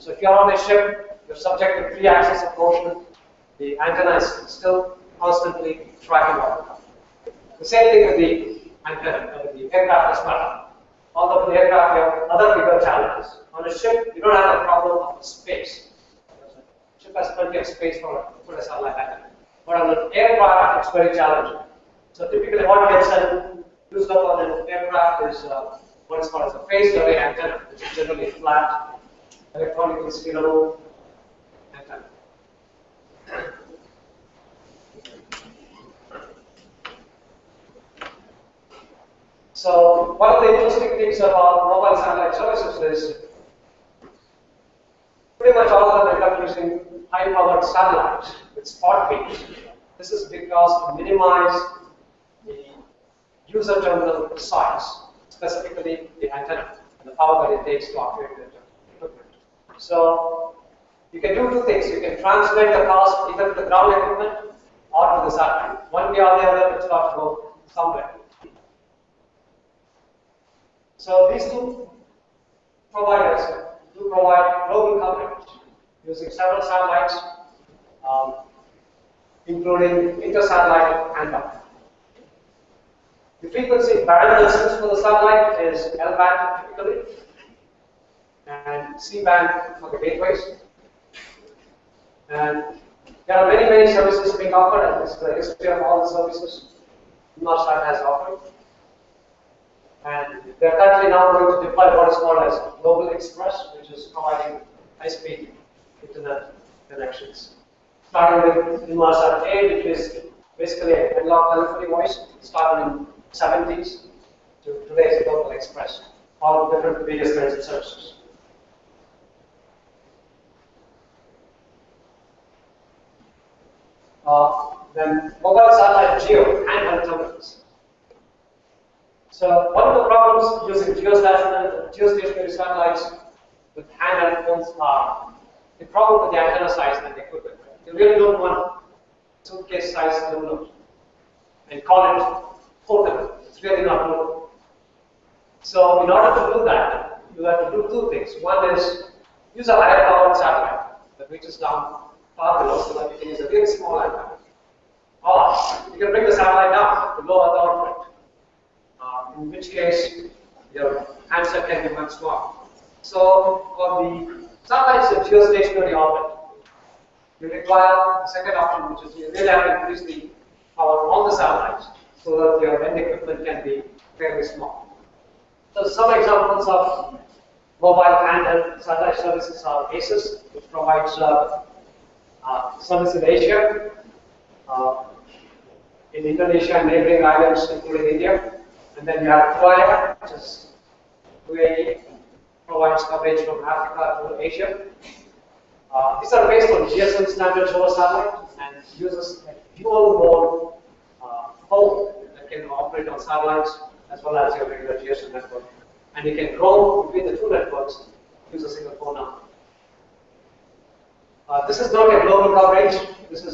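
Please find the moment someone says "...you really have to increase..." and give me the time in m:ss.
2:49.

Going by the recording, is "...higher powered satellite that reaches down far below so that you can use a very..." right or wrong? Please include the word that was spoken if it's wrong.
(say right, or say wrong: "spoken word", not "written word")
right.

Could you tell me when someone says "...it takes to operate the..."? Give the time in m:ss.
0:57.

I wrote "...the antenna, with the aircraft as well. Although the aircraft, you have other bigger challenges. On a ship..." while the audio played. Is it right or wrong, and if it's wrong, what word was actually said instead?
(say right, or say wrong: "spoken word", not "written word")
right.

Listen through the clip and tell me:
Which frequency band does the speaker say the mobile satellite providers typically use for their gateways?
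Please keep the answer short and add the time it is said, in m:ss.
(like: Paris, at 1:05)
C band, at 1:28.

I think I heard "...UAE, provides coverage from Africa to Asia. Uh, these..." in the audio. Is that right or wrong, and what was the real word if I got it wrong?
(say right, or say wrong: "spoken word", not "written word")
right.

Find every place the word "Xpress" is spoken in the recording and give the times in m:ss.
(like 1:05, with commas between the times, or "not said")
1:43, 1:55.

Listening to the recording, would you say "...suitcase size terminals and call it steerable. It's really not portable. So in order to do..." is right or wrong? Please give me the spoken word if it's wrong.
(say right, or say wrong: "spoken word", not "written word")
wrong: "portable", not "steerable".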